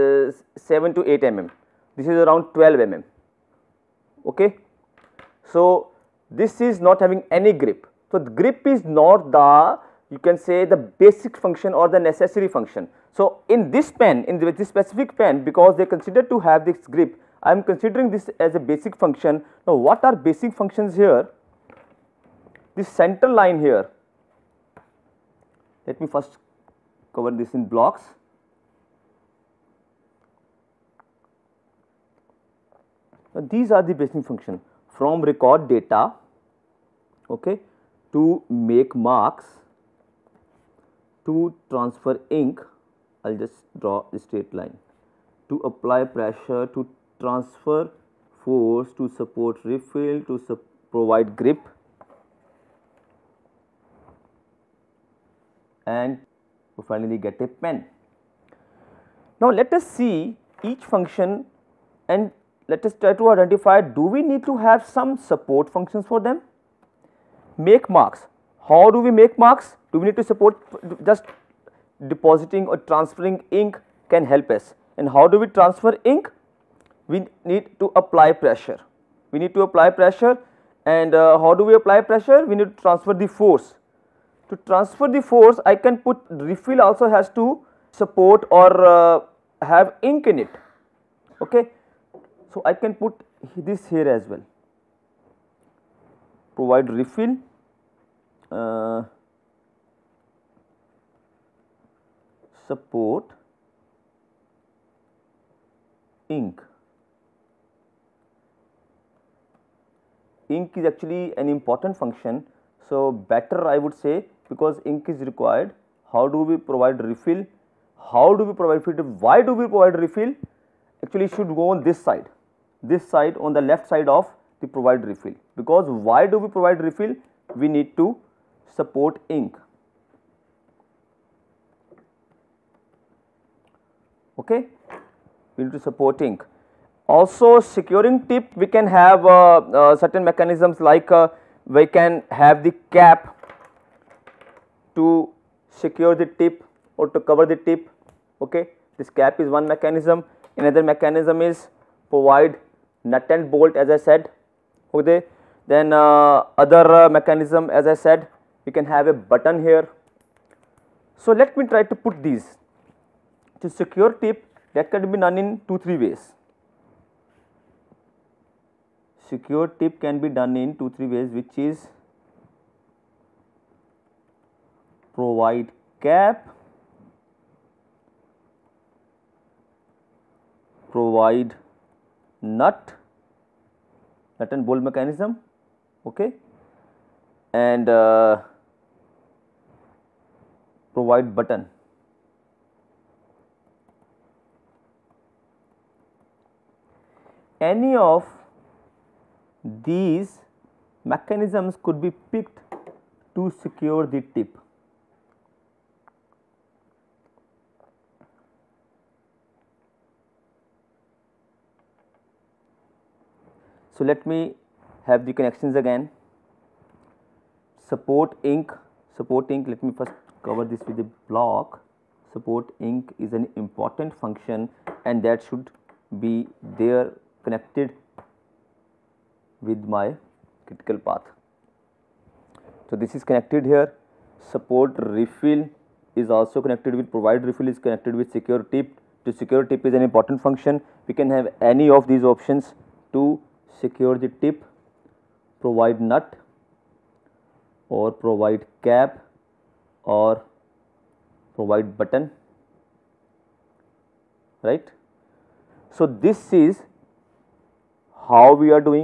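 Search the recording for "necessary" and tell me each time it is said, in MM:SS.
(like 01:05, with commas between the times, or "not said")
00:11.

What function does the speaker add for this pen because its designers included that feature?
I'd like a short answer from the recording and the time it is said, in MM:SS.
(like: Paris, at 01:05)
provide grip, at 00:50.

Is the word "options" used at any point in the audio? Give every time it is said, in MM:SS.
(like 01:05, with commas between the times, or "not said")
04:02.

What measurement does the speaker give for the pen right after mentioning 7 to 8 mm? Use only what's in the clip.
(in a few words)
12 mm.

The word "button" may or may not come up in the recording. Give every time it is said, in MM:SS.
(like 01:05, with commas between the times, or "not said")
02:39, 03:11, 04:11.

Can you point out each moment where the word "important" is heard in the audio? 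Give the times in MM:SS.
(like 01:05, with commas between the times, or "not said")
01:51, 03:43, 04:00.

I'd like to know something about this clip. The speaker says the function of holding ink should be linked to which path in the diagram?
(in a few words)
critical path.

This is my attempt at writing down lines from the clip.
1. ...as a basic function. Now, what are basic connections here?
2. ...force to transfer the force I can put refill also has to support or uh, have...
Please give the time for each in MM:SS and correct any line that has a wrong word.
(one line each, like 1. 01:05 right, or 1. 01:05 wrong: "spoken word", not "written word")
1. 00:18 wrong: "functions", not "connections"
2. 01:23 right.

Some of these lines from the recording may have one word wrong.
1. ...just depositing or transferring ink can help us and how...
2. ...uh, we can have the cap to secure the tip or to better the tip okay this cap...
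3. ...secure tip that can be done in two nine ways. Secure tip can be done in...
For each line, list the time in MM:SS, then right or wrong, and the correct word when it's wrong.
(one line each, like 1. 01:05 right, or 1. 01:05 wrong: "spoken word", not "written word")
1. 01:11 right
2. 02:21 wrong: "cover", not "better"
3. 02:43 wrong: "three", not "nine".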